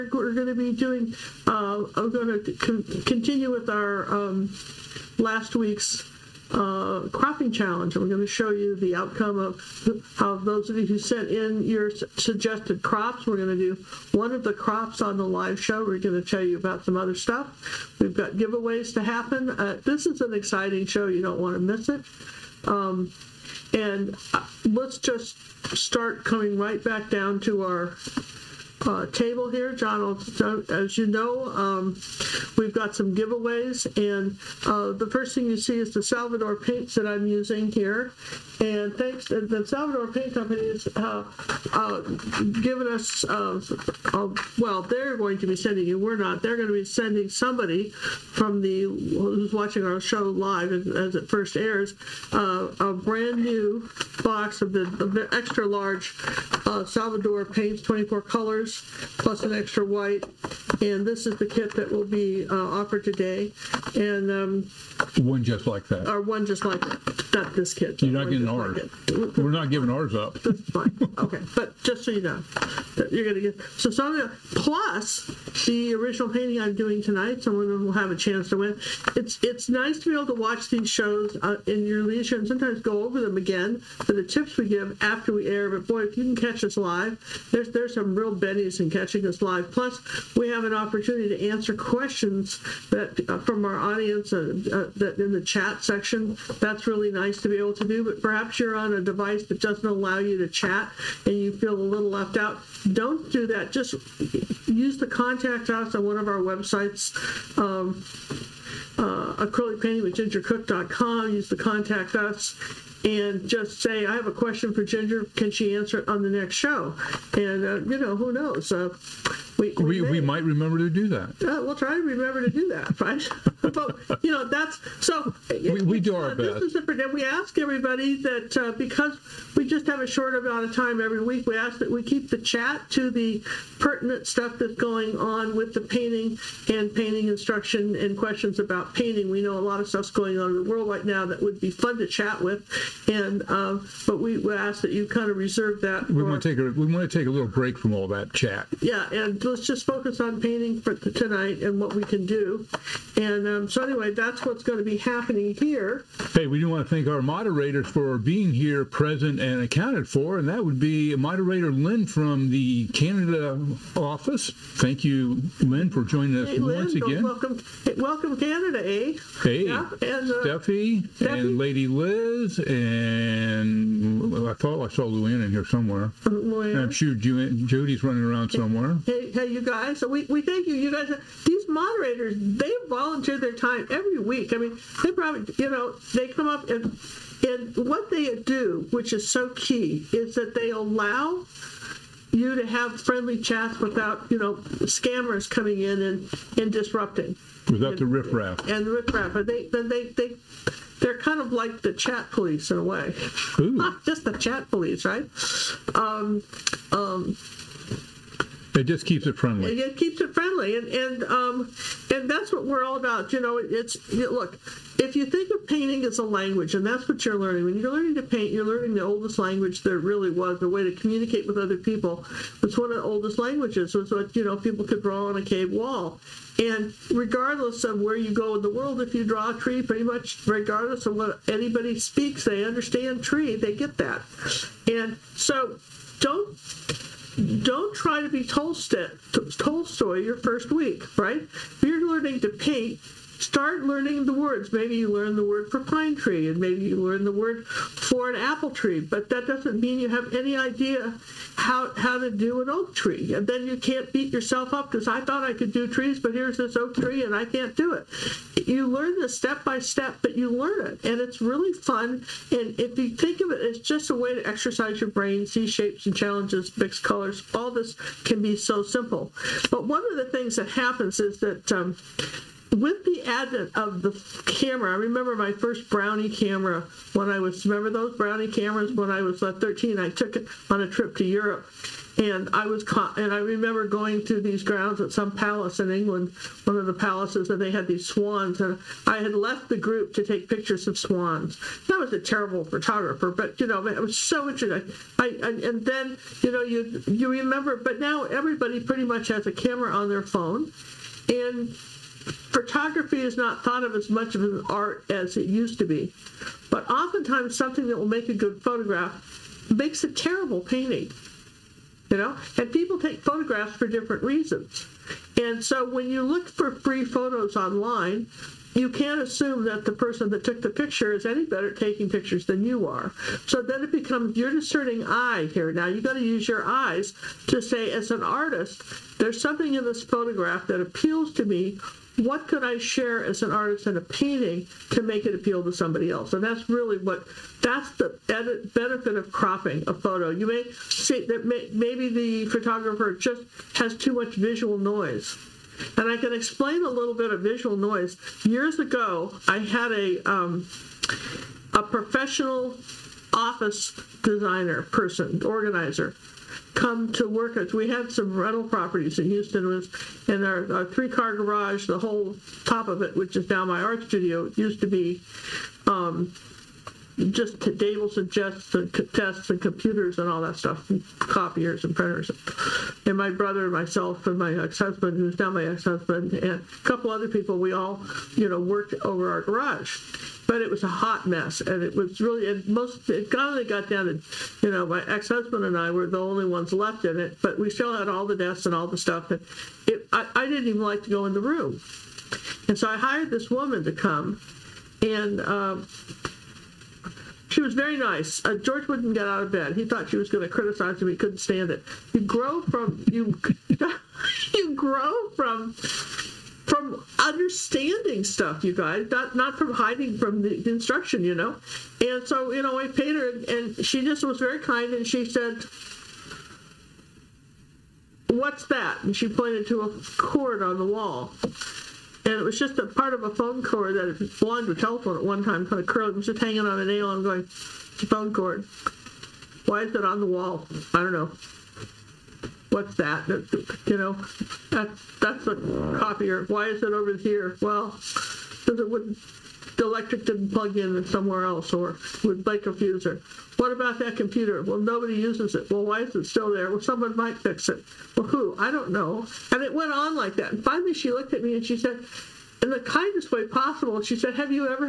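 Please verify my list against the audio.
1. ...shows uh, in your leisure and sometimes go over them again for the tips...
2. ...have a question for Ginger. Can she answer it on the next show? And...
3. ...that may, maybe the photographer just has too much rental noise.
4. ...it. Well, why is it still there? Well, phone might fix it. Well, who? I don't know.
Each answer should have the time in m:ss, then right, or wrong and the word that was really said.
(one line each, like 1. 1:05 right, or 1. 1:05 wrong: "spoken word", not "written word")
1. 1:20 right
2. 1:54 right
3. 5:41 wrong: "visual", not "rental"
4. 7:25 wrong: "someone", not "phone".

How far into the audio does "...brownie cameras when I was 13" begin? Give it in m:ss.
4:38.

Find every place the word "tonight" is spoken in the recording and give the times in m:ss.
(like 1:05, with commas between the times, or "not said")
1:17, 2:30.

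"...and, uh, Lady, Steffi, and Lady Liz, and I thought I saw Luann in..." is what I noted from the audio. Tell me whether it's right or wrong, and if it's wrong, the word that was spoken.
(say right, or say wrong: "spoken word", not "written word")
wrong: "Steffi", not "Lady".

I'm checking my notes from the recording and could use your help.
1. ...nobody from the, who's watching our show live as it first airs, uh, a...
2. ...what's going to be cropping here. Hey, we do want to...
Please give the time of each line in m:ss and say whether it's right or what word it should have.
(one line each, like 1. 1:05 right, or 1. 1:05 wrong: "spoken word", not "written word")
1. 0:47 wrong: "somebody", not "nobody"
2. 2:34 wrong: "happening", not "cropping".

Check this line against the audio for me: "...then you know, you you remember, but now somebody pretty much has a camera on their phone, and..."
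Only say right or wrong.
wrong.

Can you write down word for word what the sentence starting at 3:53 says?
They get that, and so don't don't try to be Tolstoy, Tolstoy your first week, right?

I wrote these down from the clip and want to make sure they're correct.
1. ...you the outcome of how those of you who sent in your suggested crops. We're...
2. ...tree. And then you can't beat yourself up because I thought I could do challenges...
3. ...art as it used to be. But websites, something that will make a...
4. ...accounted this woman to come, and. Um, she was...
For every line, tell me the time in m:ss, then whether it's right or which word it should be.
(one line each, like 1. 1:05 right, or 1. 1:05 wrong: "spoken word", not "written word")
1. 0:08 right
2. 4:12 wrong: "trees", not "challenges"
3. 5:04 wrong: "oftentimes", not "websites"
4. 6:32 wrong: "hired", not "accounted".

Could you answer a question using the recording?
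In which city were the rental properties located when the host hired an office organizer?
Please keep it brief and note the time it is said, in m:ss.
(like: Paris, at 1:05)
Houston, at 5:59.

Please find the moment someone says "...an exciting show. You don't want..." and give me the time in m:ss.
0:20.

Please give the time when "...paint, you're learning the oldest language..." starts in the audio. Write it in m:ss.
3:38.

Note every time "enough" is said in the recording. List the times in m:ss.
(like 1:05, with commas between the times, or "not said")
not said.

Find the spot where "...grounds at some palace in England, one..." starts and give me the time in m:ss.
4:44.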